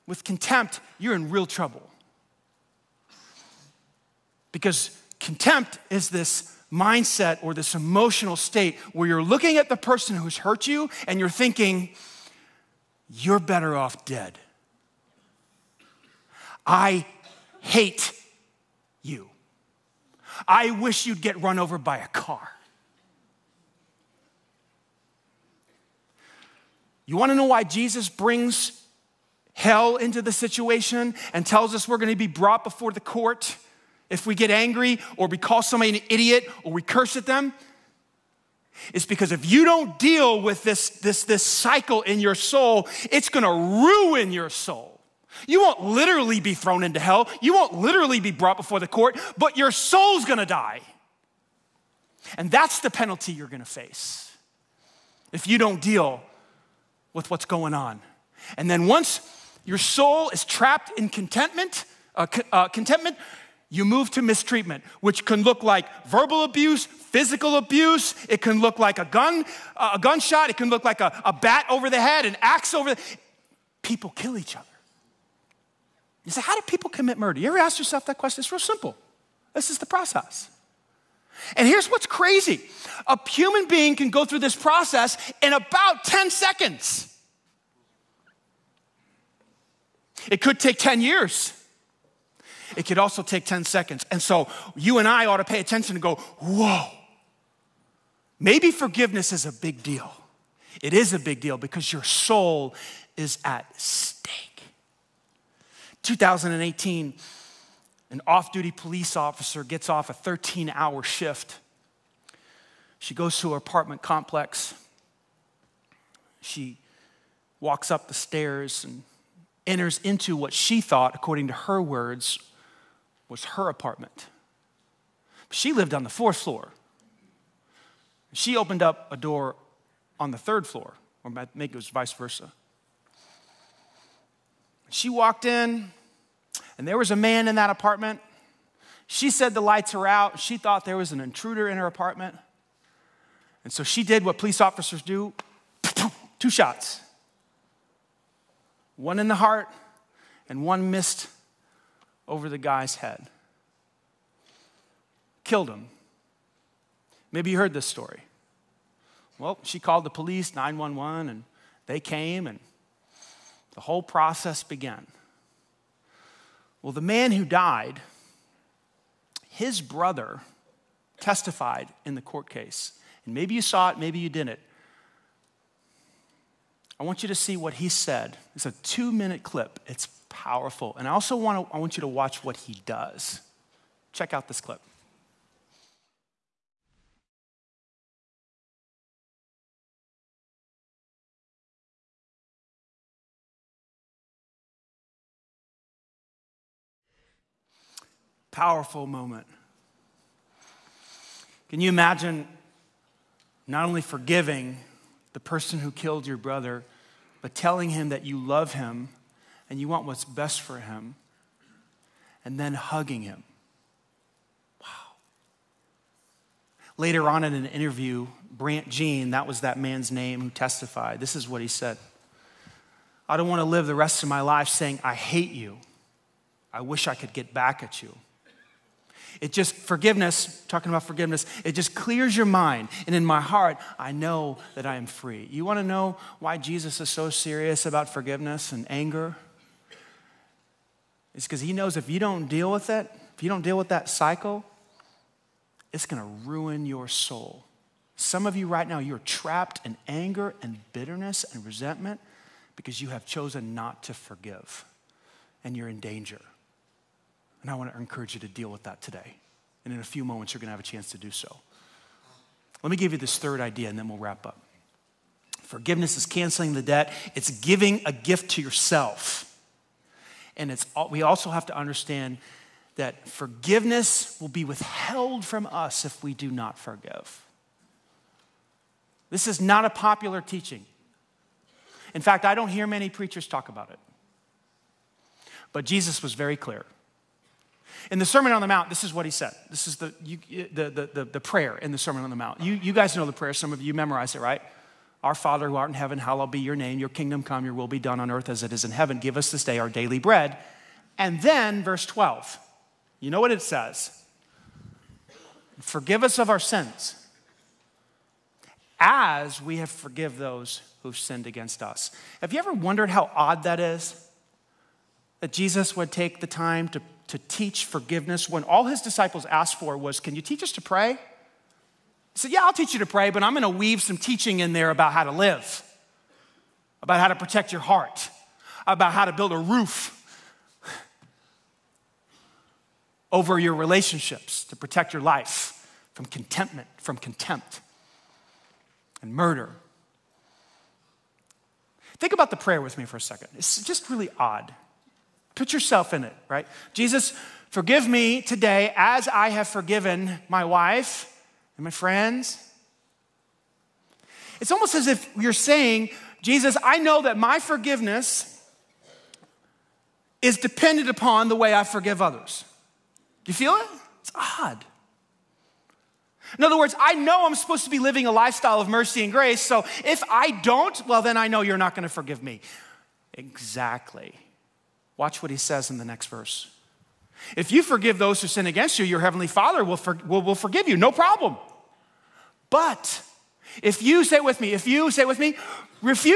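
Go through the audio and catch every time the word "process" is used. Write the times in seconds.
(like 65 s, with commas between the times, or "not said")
79 s, 84 s, 164 s.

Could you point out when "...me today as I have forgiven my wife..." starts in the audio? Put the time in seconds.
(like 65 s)
348 s.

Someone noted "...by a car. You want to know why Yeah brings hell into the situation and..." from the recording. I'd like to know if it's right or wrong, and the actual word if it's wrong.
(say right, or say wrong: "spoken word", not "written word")
wrong: "Jesus", not "Yeah".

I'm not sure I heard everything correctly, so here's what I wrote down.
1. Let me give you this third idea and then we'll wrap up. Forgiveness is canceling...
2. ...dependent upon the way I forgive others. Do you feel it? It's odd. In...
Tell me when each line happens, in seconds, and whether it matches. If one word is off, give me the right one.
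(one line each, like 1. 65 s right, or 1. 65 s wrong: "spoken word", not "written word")
1. 262 s right
2. 360 s right.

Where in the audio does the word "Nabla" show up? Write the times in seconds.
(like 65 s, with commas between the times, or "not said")
not said.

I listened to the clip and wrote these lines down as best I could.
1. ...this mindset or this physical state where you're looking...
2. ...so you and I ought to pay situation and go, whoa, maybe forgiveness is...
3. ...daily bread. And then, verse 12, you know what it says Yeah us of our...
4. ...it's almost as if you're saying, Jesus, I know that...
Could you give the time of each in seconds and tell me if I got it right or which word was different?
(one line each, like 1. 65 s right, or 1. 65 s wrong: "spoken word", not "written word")
1. 6 s wrong: "emotional", not "physical"
2. 94 s wrong: "attention", not "situation"
3. 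299 s wrong: "Forgive", not "Yeah"
4. 354 s right.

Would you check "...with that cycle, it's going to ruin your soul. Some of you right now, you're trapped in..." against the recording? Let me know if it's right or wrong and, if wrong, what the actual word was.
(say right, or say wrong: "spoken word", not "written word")
right.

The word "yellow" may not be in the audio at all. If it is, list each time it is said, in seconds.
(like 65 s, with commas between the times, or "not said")
not said.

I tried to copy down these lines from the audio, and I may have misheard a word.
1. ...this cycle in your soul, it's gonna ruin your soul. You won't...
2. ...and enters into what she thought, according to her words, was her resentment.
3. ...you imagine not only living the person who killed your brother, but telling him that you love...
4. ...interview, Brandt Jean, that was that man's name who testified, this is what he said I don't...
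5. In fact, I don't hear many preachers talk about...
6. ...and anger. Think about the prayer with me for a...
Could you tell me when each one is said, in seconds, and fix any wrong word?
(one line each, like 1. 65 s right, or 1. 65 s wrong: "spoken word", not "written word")
1. 41 s right
2. 118 s wrong: "apartment", not "resentment"
3. 201 s wrong: "forgiving", not "living"
4. 217 s right
5. 282 s right
6. 339 s wrong: "murder", not "anger".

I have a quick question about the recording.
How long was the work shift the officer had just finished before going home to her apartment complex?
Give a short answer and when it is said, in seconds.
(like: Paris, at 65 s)
13 hours, at 110 s.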